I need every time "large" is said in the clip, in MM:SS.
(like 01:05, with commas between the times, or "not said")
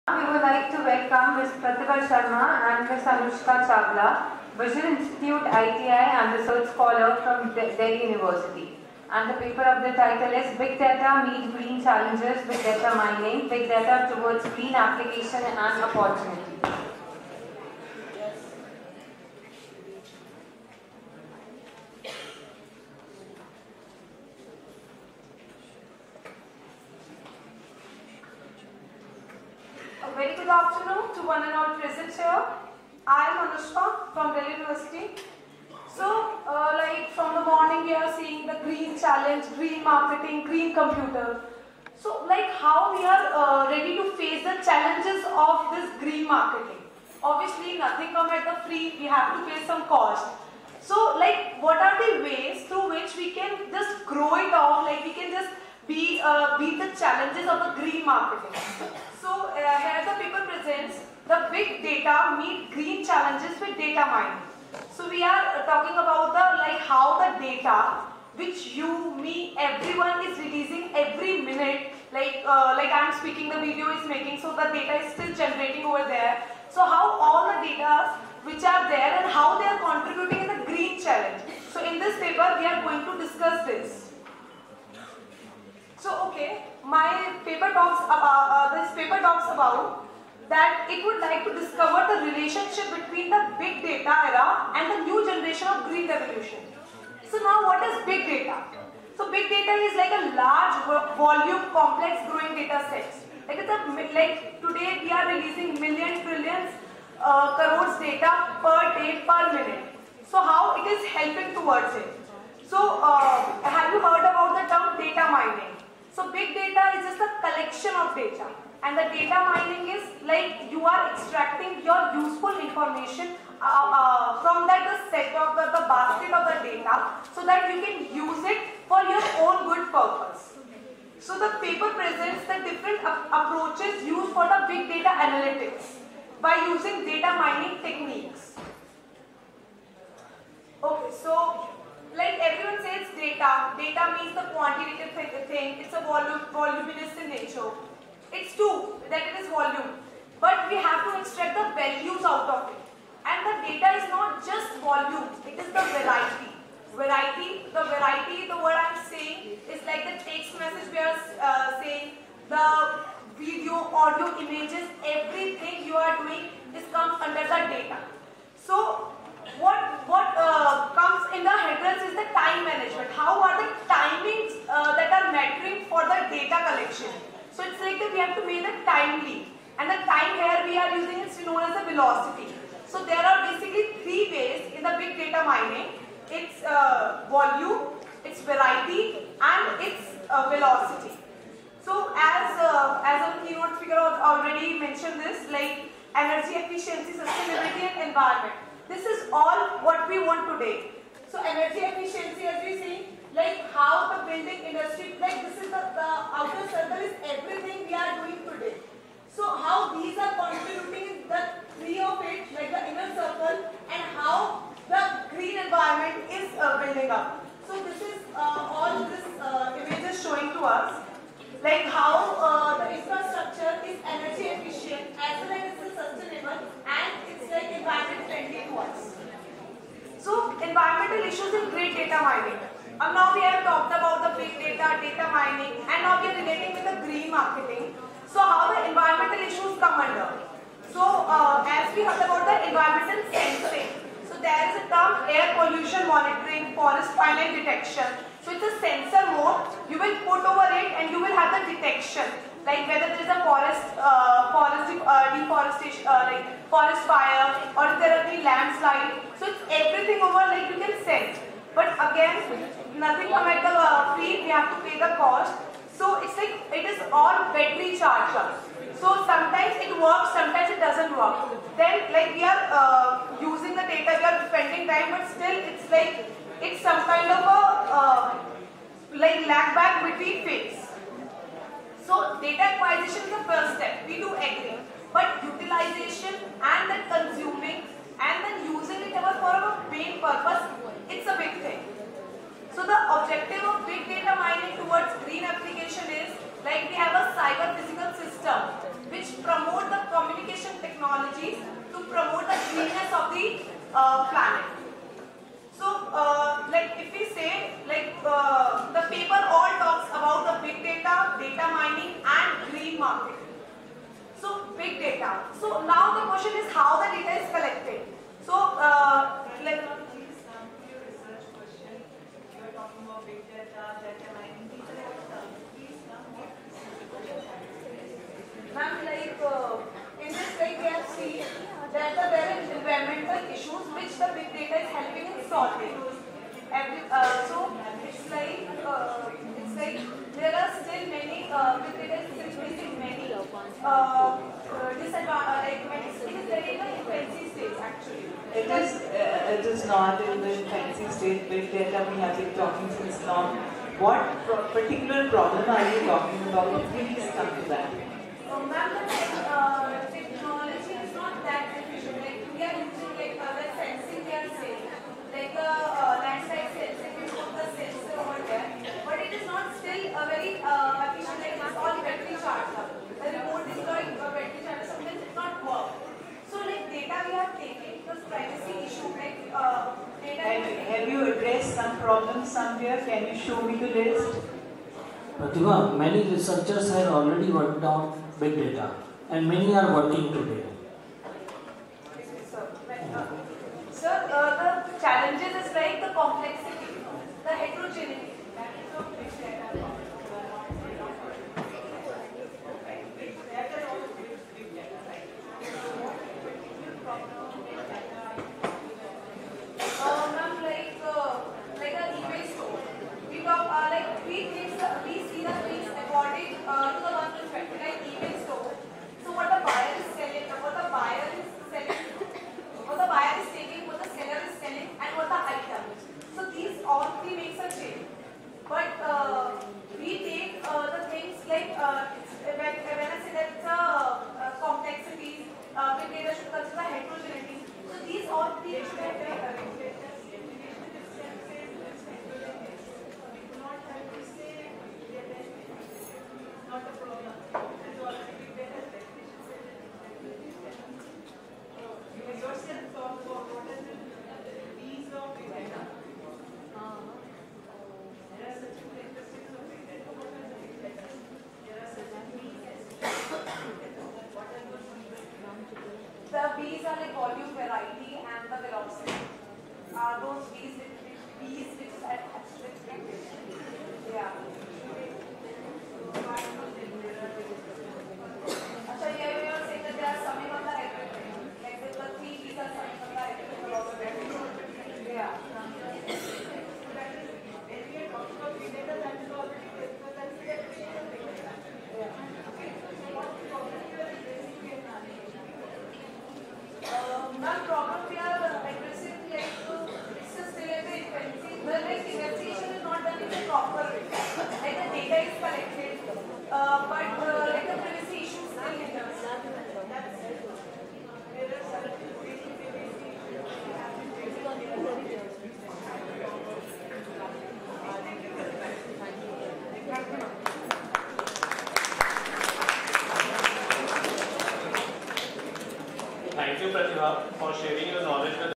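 01:40.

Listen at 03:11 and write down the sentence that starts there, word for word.
So as, uh, as our keynote speaker already mentioned this, like energy efficiency, sustainability and environment.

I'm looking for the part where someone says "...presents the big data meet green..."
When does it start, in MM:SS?
01:00.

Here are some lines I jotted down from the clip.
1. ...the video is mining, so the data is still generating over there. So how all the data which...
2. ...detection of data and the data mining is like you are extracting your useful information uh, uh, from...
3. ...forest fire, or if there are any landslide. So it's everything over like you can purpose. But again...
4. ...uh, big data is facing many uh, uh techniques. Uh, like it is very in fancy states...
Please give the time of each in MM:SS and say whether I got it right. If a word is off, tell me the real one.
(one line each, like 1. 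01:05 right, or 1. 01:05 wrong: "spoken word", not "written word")
1. 01:13 wrong: "making", not "mining"
2. 01:57 wrong: "collection", not "detection"
3. 04:16 wrong: "sense", not "purpose"
4. 05:41 wrong: "disadvantages", not "techniques".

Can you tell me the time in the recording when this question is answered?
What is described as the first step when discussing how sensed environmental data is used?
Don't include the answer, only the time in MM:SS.
04:42.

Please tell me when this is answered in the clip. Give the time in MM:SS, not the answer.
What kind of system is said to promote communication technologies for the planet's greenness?
04:57.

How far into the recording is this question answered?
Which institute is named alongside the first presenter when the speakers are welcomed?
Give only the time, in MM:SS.
00:04.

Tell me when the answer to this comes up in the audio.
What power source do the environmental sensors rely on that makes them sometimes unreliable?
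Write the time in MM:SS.
04:27.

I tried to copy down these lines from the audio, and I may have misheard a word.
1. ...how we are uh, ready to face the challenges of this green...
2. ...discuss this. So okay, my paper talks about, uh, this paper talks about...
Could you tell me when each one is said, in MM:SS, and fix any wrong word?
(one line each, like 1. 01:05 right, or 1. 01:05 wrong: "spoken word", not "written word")
1. 00:42 right
2. 01:23 right.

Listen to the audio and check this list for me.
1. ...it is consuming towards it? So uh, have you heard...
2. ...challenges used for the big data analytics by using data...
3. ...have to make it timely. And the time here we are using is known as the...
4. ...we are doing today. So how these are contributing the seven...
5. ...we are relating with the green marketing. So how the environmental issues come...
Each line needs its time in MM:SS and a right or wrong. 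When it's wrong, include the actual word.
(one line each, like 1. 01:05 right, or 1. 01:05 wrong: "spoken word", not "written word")
1. 01:50 wrong: "helping", not "consuming"
2. 02:13 wrong: "approaches", not "challenges"
3. 02:58 right
4. 03:27 wrong: "three", not "seven"
5. 03:56 right.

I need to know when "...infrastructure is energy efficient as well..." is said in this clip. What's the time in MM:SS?
03:42.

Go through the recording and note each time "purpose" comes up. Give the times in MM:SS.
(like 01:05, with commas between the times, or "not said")
02:09, 04:50.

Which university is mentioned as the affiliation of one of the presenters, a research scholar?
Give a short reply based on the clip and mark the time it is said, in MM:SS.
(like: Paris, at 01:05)
Delhi University, at 00:07.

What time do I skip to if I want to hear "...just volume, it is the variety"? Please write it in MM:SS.
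02:34.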